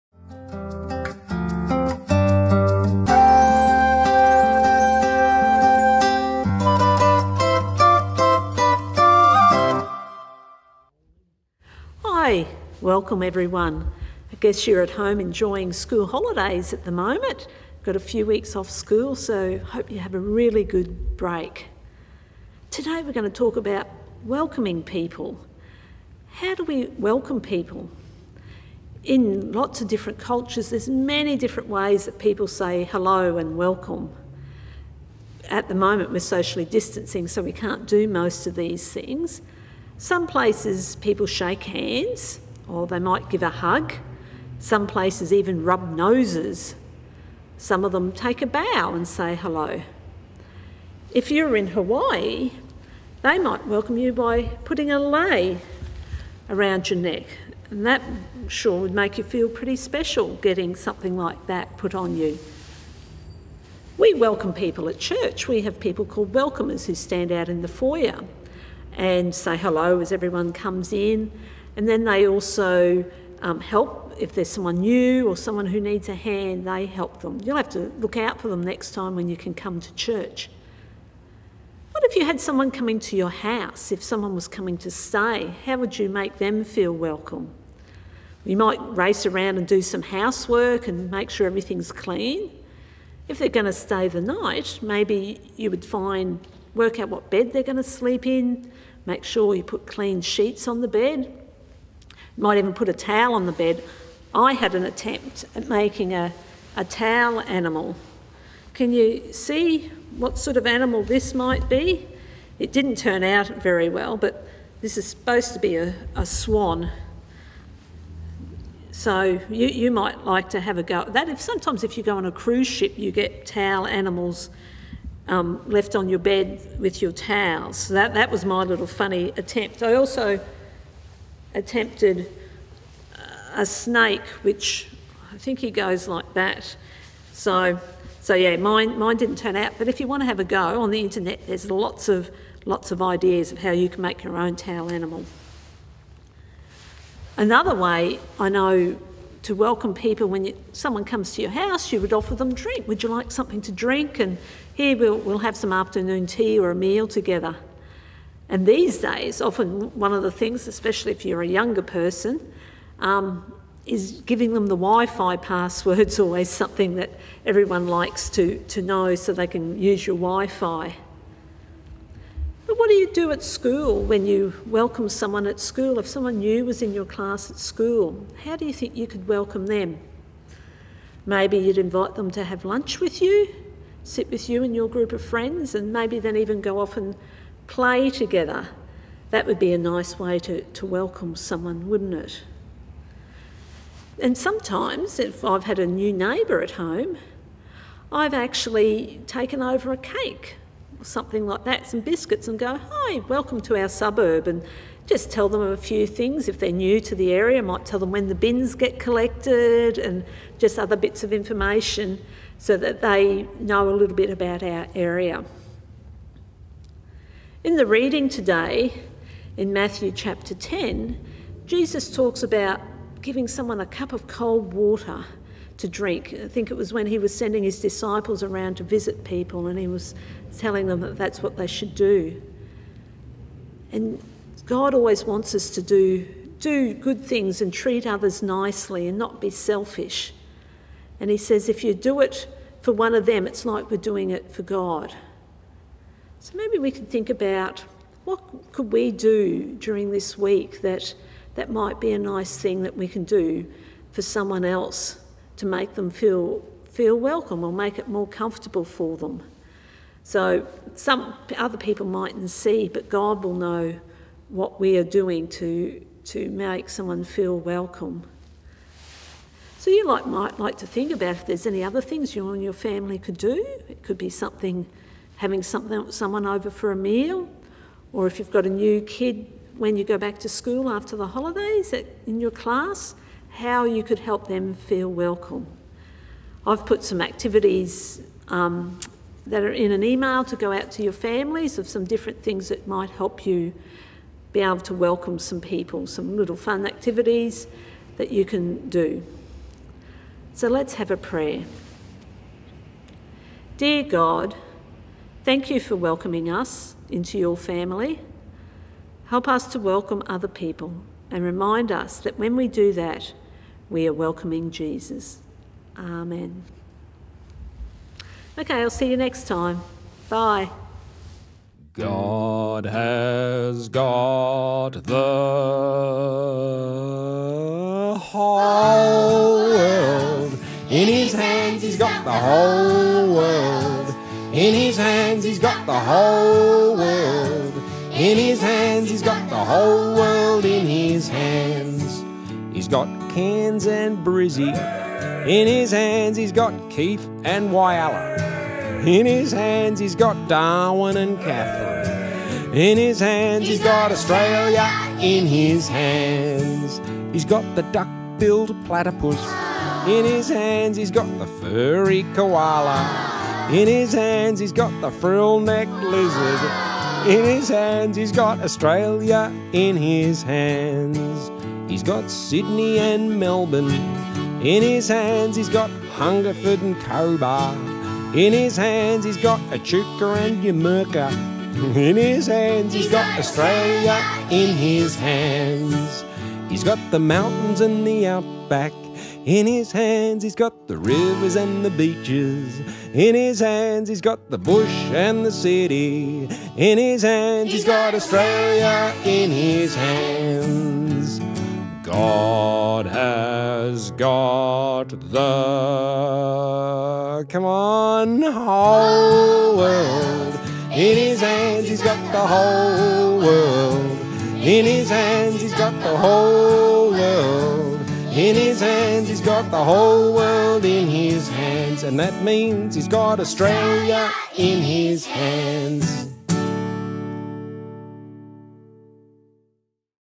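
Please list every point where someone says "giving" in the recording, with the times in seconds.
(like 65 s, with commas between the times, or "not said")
164 s, 223 s.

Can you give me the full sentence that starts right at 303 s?
Dear God, Thank you for welcoming us into your family.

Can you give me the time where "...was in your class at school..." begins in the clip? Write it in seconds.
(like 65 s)
176 s.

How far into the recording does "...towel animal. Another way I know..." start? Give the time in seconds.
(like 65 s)
144 s.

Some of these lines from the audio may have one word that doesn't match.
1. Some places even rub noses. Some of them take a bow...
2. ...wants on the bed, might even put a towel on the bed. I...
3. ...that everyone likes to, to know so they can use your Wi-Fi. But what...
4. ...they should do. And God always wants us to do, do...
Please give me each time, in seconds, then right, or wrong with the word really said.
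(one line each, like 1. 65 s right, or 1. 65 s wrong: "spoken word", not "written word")
1. 44 s right
2. 100 s wrong: "sheets", not "wants"
3. 166 s right
4. 231 s right.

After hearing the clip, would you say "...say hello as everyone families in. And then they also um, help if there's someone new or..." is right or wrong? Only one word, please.
wrong.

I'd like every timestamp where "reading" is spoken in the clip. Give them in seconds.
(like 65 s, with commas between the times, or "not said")
217 s.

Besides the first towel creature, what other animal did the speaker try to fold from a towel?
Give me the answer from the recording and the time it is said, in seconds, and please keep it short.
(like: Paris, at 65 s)
Snake, at 133 s.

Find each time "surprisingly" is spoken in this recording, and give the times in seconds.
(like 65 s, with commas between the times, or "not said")
not said.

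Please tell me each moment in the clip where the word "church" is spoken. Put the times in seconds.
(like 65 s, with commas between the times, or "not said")
64 s, 79 s.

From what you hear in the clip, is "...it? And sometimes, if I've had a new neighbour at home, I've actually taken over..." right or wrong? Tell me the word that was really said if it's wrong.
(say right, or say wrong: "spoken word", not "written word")
right.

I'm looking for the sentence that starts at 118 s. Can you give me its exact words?
So you, you might like to have a go at that.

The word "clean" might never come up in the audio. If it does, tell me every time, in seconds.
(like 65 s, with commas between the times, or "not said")
91 s, 99 s.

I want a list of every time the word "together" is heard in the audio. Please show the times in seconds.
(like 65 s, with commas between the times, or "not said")
157 s, 188 s.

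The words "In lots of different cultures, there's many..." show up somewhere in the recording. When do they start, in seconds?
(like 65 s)
29 s.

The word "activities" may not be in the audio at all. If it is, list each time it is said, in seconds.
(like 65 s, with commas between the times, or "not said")
287 s, 296 s.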